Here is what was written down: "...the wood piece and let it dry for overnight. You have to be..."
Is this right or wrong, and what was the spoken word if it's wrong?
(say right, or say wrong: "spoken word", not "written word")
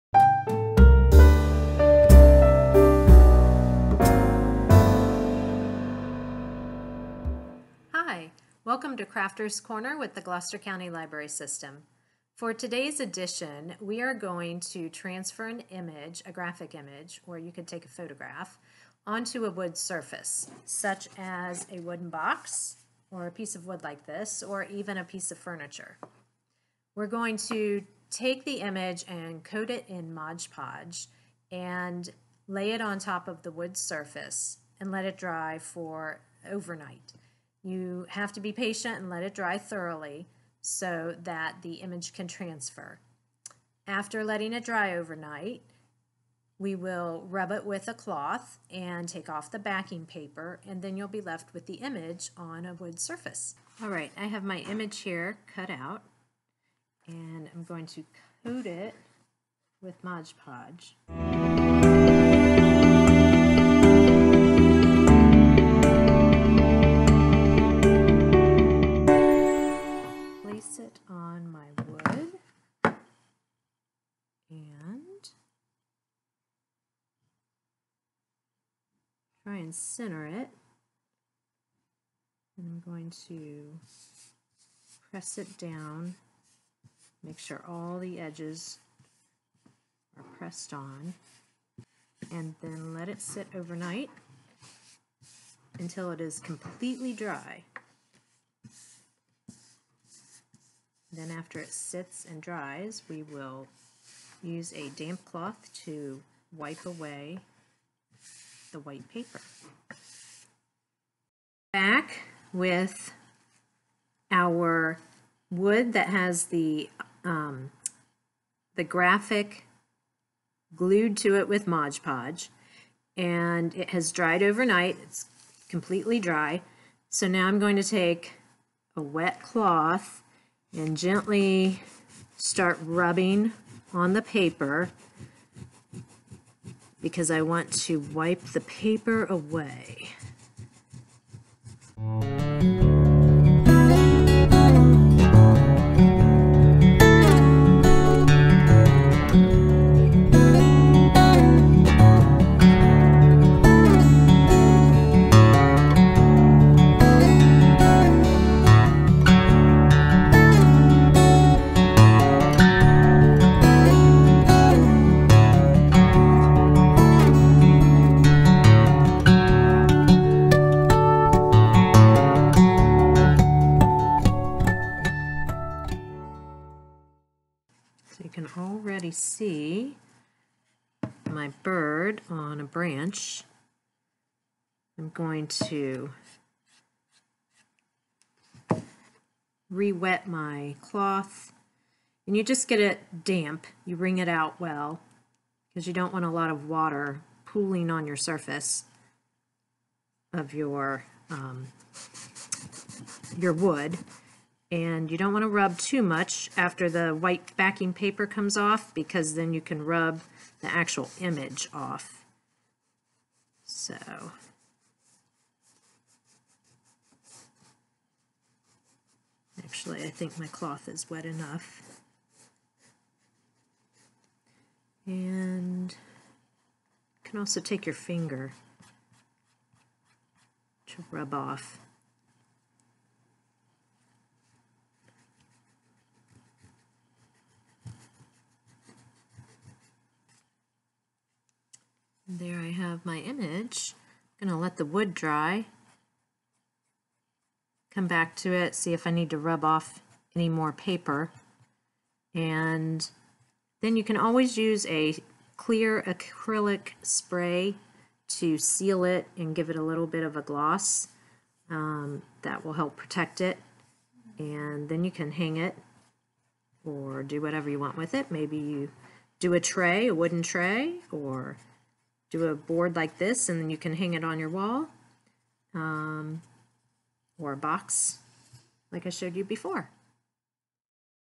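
wrong: "surface", not "piece".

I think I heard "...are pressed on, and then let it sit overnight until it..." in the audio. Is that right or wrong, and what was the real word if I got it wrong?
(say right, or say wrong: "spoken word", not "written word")
right.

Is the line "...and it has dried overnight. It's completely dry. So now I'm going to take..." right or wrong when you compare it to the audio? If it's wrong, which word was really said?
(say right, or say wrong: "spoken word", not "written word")
right.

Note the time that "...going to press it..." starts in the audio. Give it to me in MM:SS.
01:22.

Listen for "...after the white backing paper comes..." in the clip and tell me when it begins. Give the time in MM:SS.
03:26.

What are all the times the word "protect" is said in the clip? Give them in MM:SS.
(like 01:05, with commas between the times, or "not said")
04:22.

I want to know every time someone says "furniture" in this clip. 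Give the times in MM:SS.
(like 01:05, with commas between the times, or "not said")
00:25.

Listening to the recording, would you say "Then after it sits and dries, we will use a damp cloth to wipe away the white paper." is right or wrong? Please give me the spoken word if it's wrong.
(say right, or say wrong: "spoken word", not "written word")
right.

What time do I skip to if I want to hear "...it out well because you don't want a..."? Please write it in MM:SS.
03:14.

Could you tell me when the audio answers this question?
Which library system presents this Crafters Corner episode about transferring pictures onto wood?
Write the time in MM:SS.
00:10.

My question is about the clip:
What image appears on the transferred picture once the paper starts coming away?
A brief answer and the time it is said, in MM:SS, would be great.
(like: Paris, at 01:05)
bird on a branch, at 03:01.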